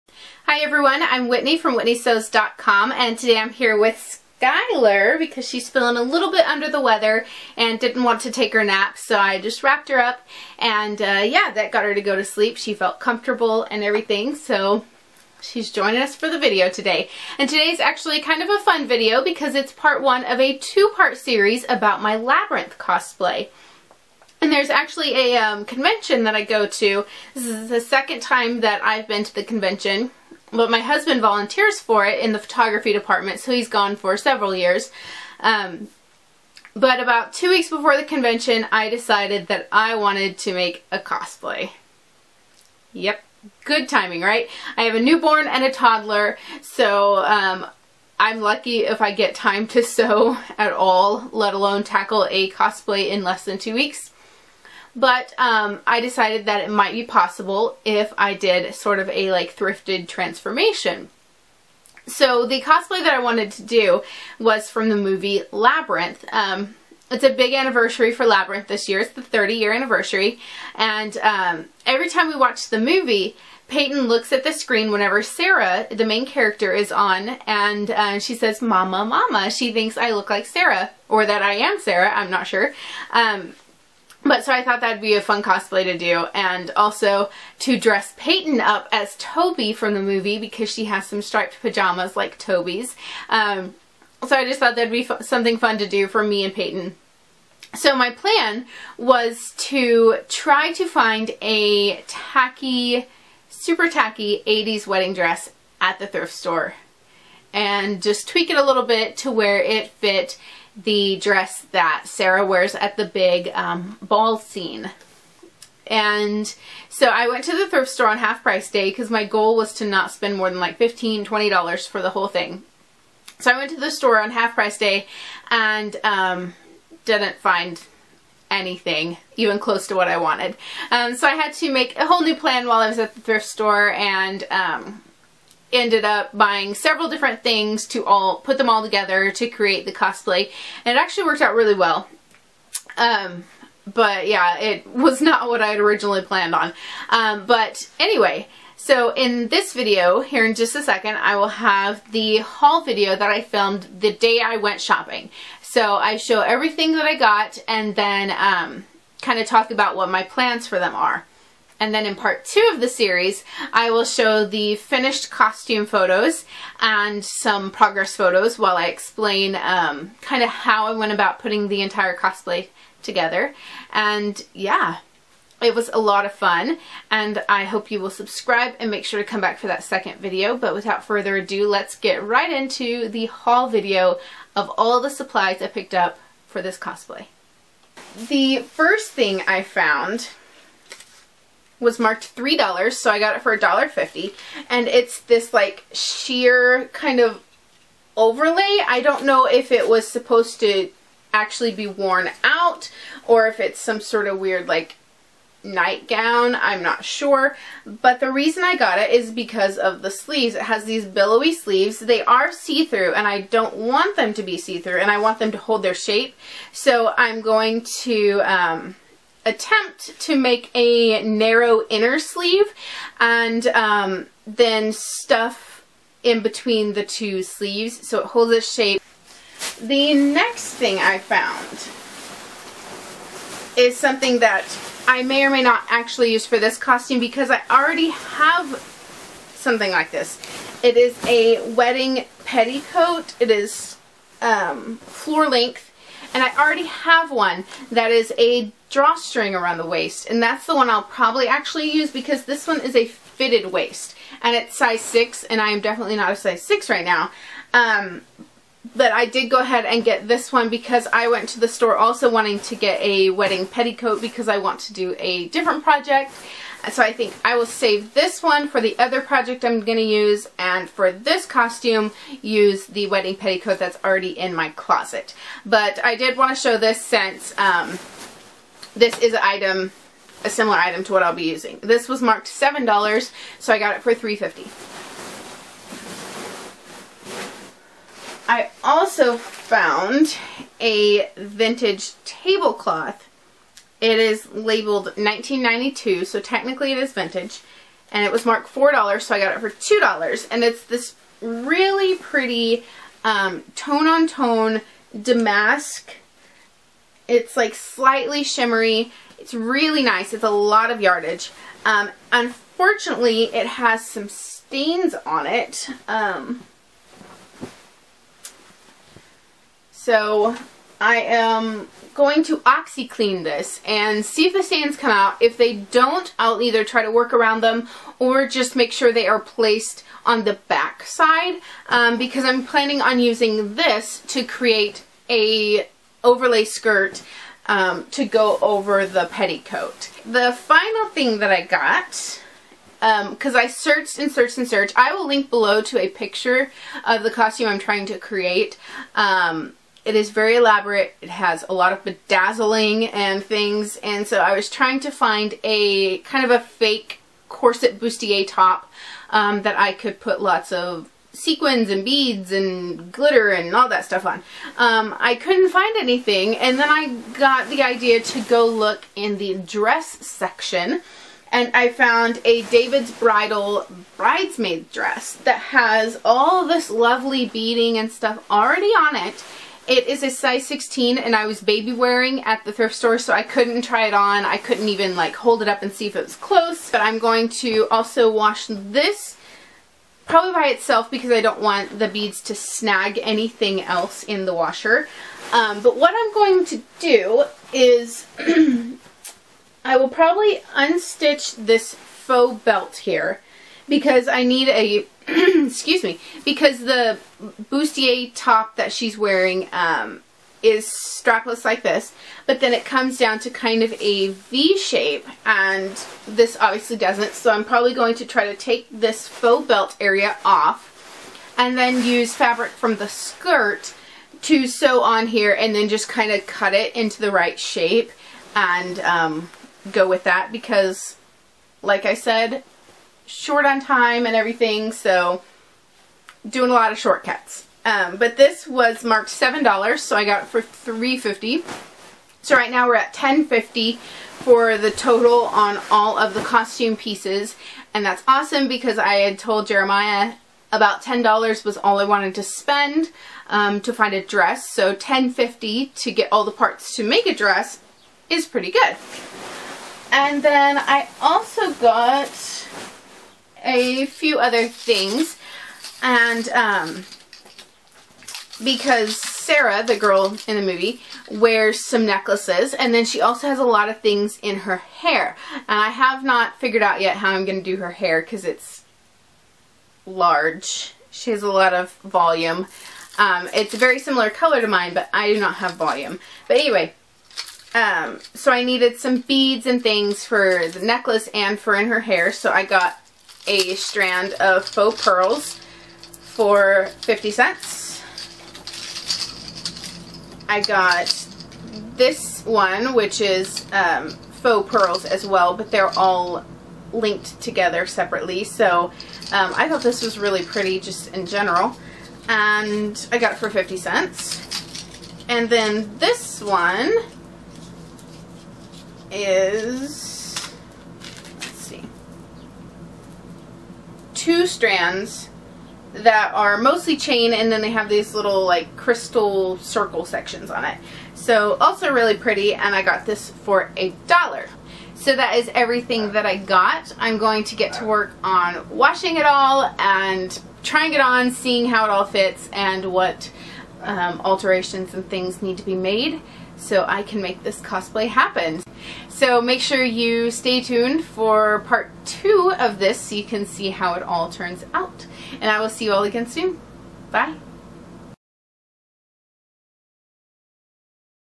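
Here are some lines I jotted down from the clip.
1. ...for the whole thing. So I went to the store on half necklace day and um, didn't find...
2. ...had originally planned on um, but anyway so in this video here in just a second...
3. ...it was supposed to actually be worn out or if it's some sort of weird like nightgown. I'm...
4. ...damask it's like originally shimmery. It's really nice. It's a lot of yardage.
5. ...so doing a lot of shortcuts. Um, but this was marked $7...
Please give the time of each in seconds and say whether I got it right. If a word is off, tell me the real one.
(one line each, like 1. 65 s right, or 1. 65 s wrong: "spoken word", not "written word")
1. 121 s wrong: "price", not "necklace"
2. 145 s right
3. 199 s right
4. 305 s wrong: "slightly", not "originally"
5. 434 s right.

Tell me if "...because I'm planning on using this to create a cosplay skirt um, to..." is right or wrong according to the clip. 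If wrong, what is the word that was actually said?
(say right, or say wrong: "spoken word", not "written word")
wrong: "overlay", not "cosplay".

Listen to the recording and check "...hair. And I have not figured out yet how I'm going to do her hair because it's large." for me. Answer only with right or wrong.
right.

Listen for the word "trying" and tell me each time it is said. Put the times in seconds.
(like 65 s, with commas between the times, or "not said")
347 s, 354 s, 540 s.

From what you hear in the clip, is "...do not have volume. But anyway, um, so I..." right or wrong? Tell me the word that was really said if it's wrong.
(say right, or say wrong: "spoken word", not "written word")
right.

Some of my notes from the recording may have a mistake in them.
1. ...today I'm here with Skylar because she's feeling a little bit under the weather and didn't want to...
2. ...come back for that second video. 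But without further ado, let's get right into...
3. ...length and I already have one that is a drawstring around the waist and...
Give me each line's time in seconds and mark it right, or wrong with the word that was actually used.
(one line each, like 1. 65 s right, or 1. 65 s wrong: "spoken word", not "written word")
1. 3 s right
2. 179 s right
3. 245 s right.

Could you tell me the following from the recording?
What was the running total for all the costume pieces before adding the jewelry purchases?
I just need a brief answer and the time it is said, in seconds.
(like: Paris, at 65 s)
$10.50, at 443 s.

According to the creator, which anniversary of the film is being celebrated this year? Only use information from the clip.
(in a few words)
30 year anniversary.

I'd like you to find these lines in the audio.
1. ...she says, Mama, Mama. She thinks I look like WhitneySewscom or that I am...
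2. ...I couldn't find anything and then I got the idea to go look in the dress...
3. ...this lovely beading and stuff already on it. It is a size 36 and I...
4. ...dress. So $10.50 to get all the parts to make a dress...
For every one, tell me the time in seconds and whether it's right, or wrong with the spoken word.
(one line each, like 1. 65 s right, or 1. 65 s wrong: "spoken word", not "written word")
1. 78 s wrong: "Sarah", not "WhitneySewscom"
2. 365 s right
3. 376 s wrong: "16", not "36"
4. 454 s right.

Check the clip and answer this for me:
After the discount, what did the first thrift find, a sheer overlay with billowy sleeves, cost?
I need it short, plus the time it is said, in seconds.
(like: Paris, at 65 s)
$1.50, at 193 s.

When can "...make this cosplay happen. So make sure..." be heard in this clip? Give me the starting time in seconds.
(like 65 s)
547 s.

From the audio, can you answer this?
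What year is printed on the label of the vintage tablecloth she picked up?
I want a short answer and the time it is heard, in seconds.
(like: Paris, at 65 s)
1992, at 295 s.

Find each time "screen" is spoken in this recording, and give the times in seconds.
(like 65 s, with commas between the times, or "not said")
74 s.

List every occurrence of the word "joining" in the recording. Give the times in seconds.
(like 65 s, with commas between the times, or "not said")
15 s.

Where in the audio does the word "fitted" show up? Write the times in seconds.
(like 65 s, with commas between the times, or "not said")
253 s.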